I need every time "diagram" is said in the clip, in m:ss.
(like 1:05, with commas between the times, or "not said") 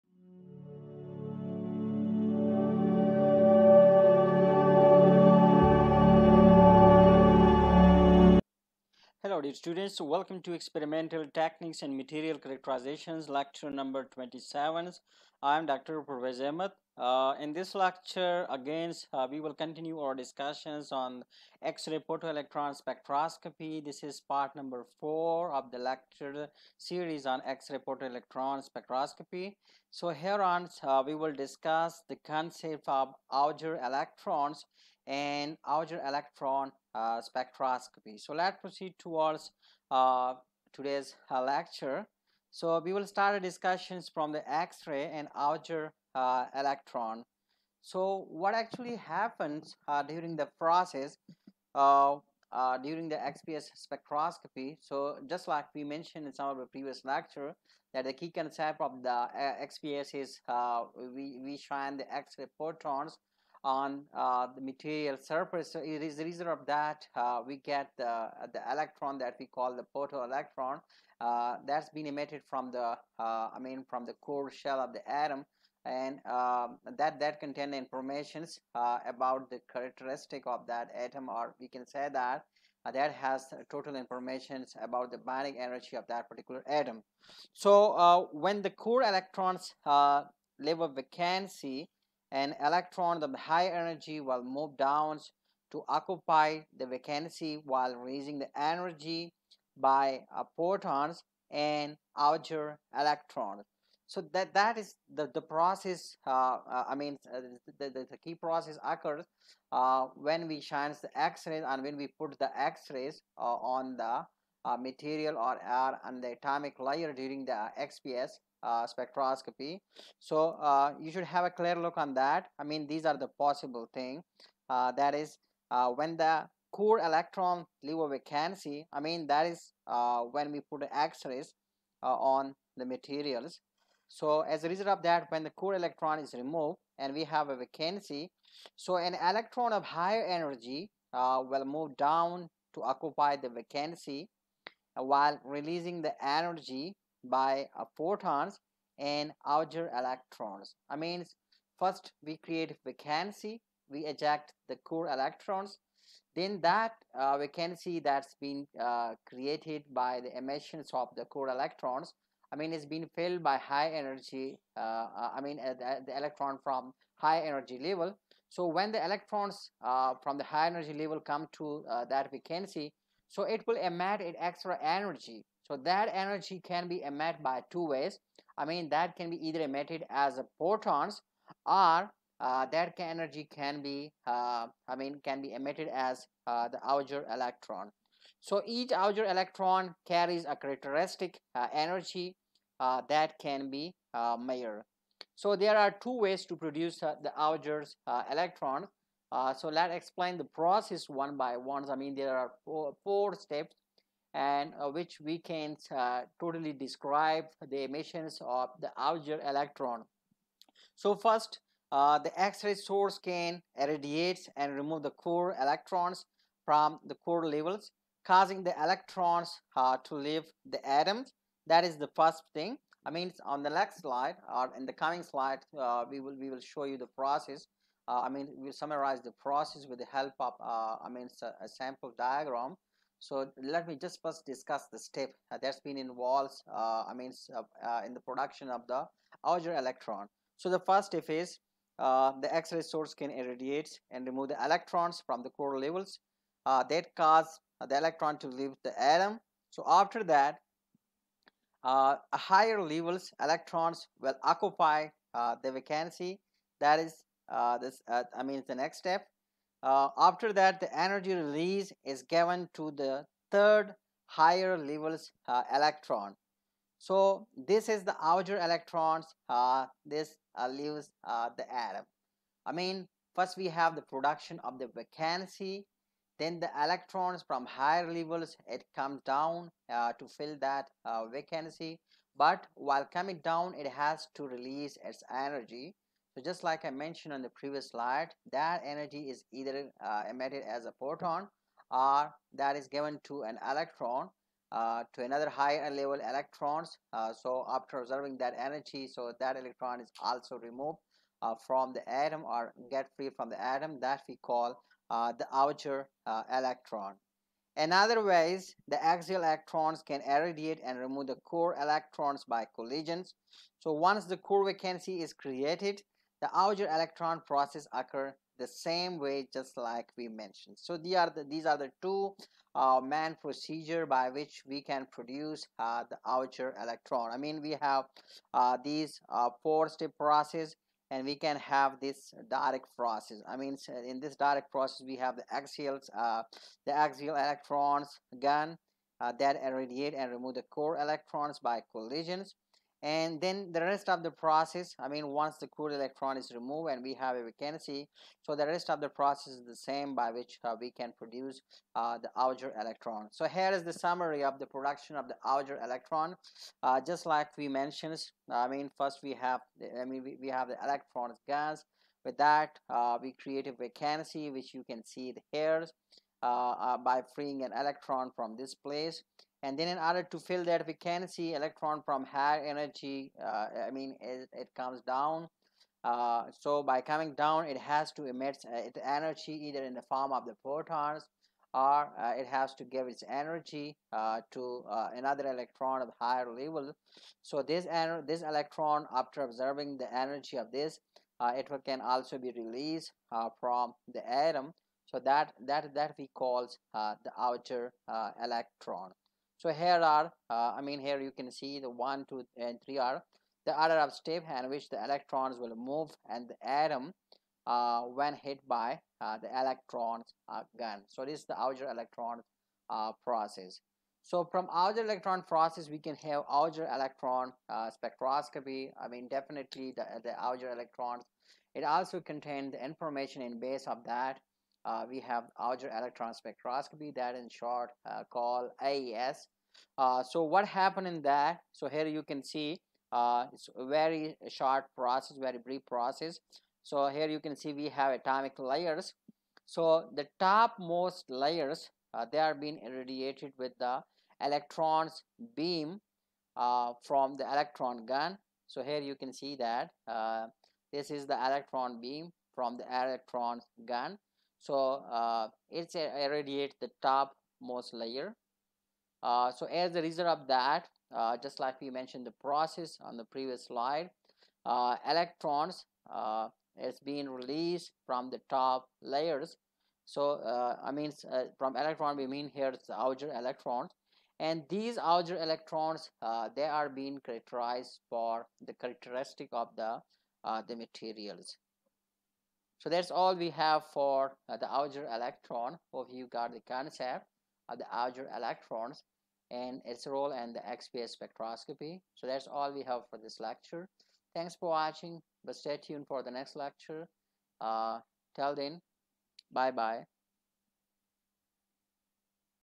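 3:52.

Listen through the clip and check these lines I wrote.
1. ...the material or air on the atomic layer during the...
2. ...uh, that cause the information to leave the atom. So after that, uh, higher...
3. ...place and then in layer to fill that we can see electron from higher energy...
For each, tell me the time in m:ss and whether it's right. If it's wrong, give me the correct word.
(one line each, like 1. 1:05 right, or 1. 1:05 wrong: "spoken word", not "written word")
1. 1:53 right
2. 4:06 wrong: "electron", not "information"
3. 6:08 wrong: "order", not "layer".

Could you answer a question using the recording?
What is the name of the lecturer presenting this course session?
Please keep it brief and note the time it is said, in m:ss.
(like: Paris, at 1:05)
Dr. Pervaiz Ahmad, at 0:15.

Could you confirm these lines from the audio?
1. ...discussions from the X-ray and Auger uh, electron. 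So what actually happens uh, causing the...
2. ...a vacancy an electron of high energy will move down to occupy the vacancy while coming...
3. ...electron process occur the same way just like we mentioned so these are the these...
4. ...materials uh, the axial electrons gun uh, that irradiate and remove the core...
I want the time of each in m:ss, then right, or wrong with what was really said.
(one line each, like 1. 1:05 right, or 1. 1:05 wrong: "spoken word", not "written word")
1. 0:43 wrong: "during", not "causing"
2. 1:30 wrong: "raising", not "coming"
3. 5:16 right
4. 5:35 wrong: "axials", not "materials".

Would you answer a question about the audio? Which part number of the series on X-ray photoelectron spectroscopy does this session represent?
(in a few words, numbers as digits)
4.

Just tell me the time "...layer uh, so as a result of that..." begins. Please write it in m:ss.
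7:37.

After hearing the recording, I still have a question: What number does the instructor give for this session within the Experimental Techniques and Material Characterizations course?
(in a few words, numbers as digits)
27.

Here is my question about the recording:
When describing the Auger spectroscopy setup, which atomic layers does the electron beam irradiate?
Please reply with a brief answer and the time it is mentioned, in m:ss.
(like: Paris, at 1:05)
topmost layers, at 7:20.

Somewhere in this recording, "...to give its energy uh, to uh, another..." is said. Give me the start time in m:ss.
6:22.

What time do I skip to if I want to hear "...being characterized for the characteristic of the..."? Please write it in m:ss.
7:56.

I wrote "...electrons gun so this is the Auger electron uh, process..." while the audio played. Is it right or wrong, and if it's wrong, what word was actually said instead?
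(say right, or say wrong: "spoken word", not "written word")
right.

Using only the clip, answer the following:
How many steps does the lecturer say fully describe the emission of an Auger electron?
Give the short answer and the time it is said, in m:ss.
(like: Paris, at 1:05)
4, at 3:23.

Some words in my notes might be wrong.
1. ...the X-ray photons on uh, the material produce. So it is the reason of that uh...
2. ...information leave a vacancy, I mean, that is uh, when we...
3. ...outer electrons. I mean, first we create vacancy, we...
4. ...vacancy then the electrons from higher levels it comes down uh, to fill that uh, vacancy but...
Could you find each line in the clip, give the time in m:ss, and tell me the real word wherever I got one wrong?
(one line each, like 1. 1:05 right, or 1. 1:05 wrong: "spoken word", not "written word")
1. 1:01 wrong: "surface", not "produce"
2. 2:06 wrong: "electron", not "information"
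3. 2:29 right
4. 4:34 right.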